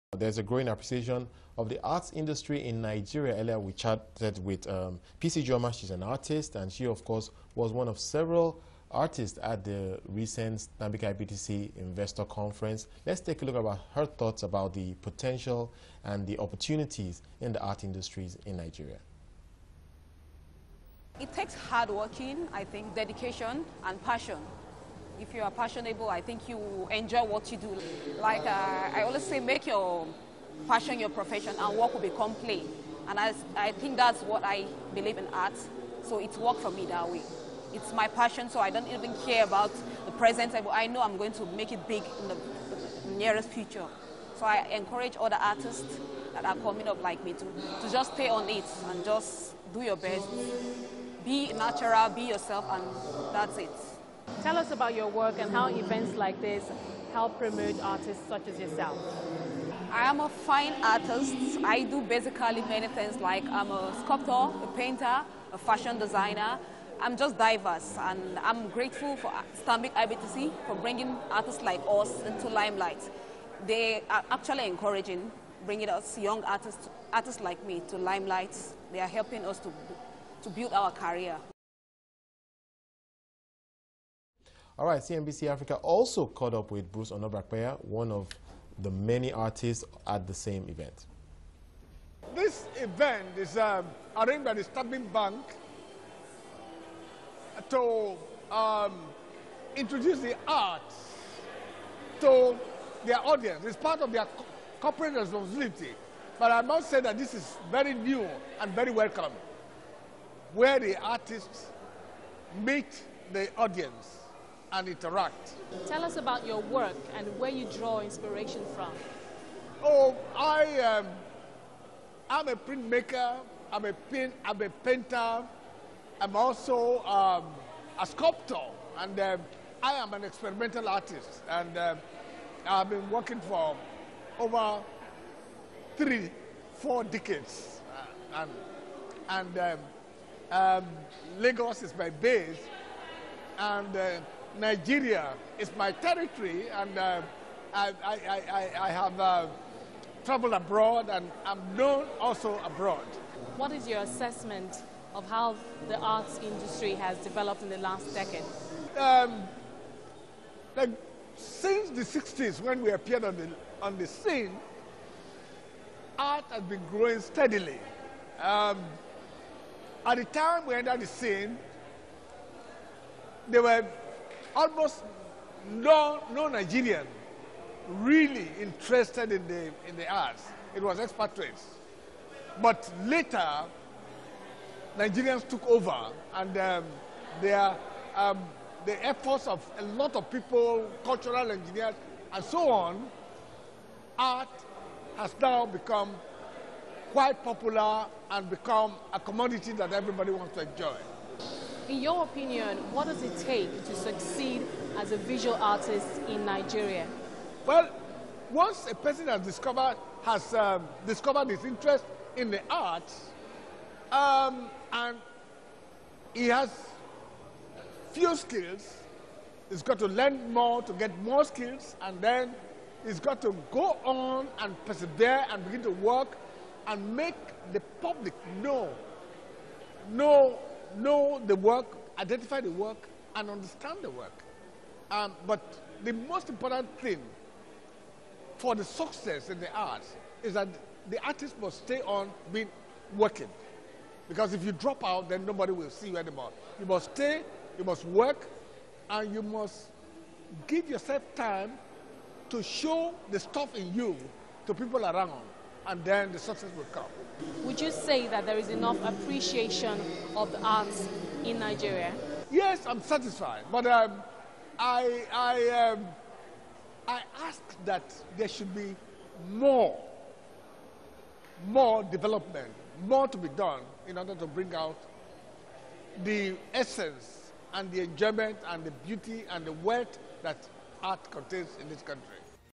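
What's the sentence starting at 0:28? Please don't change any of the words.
Like uh, I always say, make your passion your profession, and work will become play.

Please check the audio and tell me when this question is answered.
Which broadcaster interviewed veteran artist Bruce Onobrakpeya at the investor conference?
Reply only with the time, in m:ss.
1:24.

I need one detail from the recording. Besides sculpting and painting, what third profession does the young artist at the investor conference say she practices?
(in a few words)
Fashion designer.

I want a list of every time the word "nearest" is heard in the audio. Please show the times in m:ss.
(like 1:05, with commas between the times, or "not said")
0:43.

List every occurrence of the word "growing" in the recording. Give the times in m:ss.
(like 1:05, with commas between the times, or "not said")
0:00, 2:46.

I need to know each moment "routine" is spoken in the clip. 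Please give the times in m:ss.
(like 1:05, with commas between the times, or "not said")
not said.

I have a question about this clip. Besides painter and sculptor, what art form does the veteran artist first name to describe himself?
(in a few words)
Printmaker.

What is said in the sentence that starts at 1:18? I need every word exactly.
They are helping us to, to build our career.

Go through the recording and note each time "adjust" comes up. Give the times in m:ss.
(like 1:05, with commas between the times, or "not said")
not said.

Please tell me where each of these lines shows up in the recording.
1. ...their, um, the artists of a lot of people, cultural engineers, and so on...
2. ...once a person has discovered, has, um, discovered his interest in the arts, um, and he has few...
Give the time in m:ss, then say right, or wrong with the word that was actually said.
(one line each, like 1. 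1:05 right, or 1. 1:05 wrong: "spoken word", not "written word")
1. 3:07 wrong: "efforts", not "artists"
2. 3:28 right.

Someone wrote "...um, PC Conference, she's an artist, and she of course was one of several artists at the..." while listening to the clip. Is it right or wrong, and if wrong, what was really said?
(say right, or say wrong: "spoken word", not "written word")
wrong: "Joma", not "Conference".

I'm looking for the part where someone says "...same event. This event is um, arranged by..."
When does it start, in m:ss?
1:30.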